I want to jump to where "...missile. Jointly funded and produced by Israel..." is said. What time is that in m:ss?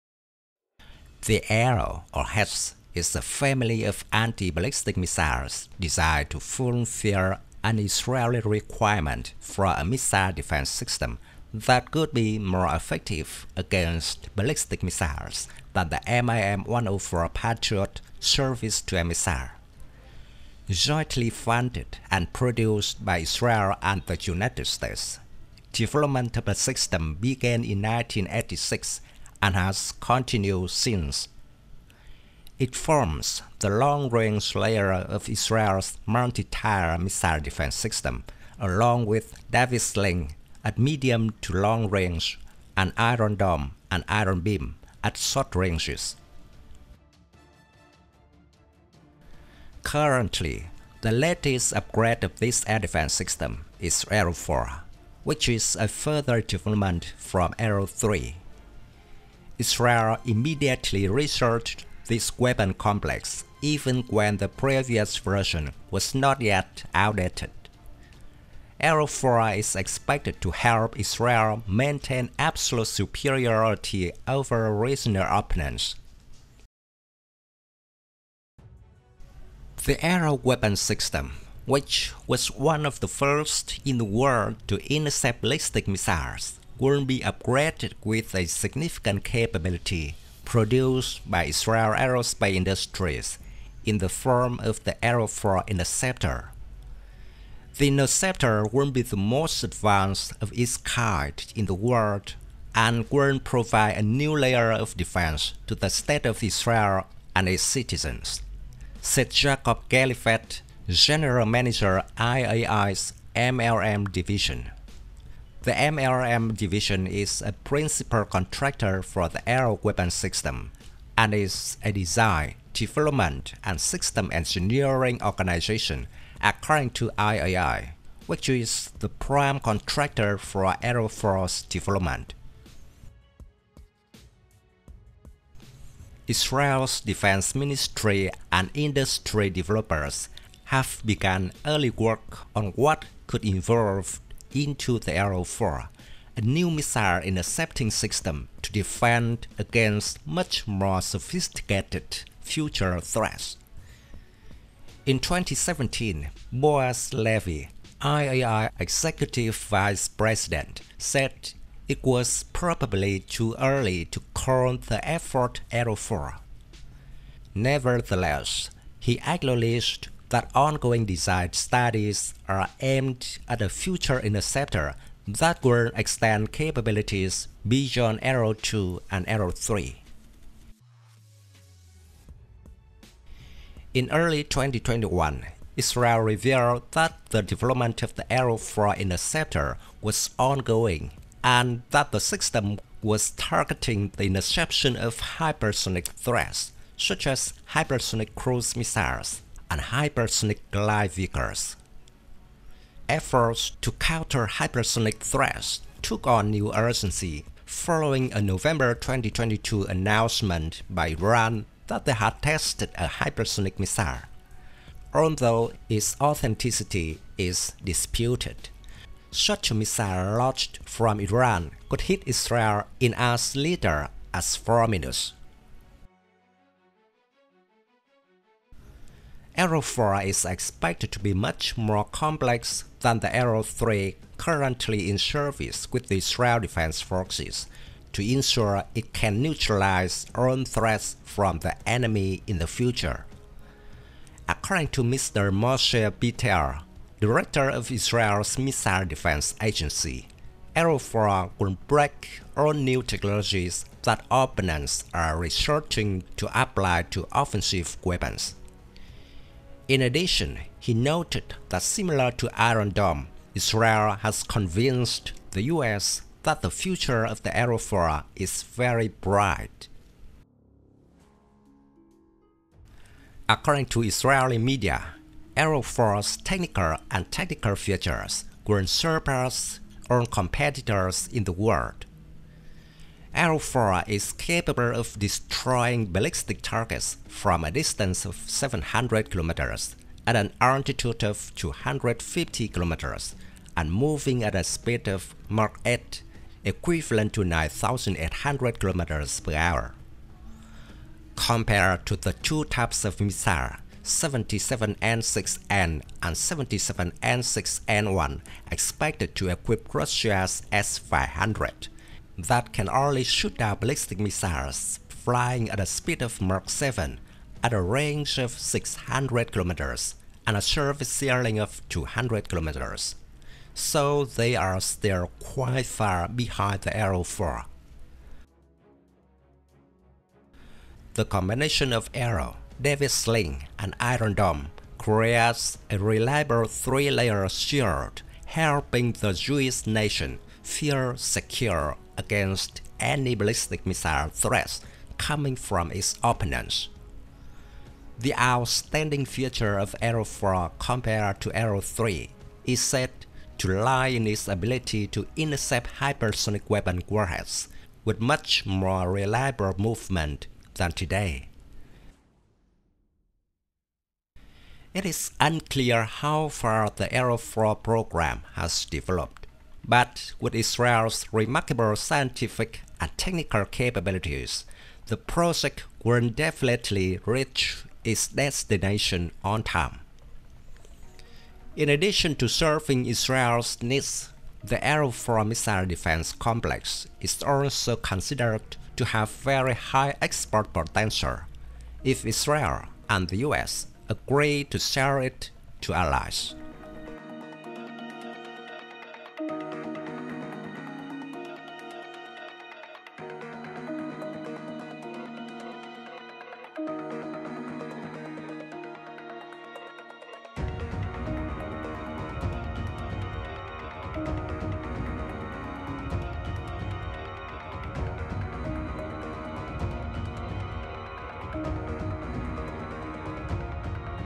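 0:19.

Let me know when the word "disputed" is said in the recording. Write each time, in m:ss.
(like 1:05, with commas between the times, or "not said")
3:37.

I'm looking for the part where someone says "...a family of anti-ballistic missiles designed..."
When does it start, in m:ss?
0:03.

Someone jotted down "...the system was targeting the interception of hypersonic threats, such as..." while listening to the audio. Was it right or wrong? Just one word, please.
right.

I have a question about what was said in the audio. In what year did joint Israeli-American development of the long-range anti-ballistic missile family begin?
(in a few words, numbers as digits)
1986.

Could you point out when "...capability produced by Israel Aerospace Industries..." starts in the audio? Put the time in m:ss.
1:29.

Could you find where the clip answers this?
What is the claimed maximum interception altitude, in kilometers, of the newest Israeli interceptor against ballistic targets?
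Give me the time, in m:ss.
4:51.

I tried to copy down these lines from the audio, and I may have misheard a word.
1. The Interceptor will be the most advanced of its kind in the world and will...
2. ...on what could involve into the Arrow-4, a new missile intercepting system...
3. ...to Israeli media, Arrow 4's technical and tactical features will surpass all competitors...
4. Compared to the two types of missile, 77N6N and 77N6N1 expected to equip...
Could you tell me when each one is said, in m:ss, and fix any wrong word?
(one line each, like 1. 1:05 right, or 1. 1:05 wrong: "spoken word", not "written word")
1. 1:37 right
2. 2:22 right
3. 4:33 right
4. 5:01 right.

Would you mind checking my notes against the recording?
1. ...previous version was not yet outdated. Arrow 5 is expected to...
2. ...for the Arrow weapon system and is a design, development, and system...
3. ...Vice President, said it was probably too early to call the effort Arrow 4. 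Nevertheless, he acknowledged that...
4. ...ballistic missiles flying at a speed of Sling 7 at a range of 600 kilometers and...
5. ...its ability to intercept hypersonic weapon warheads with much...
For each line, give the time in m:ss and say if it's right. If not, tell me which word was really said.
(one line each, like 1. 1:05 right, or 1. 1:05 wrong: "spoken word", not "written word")
1. 1:04 wrong: "4", not "5"
2. 1:59 right
3. 2:39 right
4. 5:13 wrong: "Mach", not "Sling"
5. 5:54 right.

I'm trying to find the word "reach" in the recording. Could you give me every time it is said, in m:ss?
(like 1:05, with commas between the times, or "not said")
6:17.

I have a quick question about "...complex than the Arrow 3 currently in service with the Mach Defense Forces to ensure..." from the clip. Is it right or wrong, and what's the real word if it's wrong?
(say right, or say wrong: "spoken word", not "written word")
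wrong: "Israel", not "Mach".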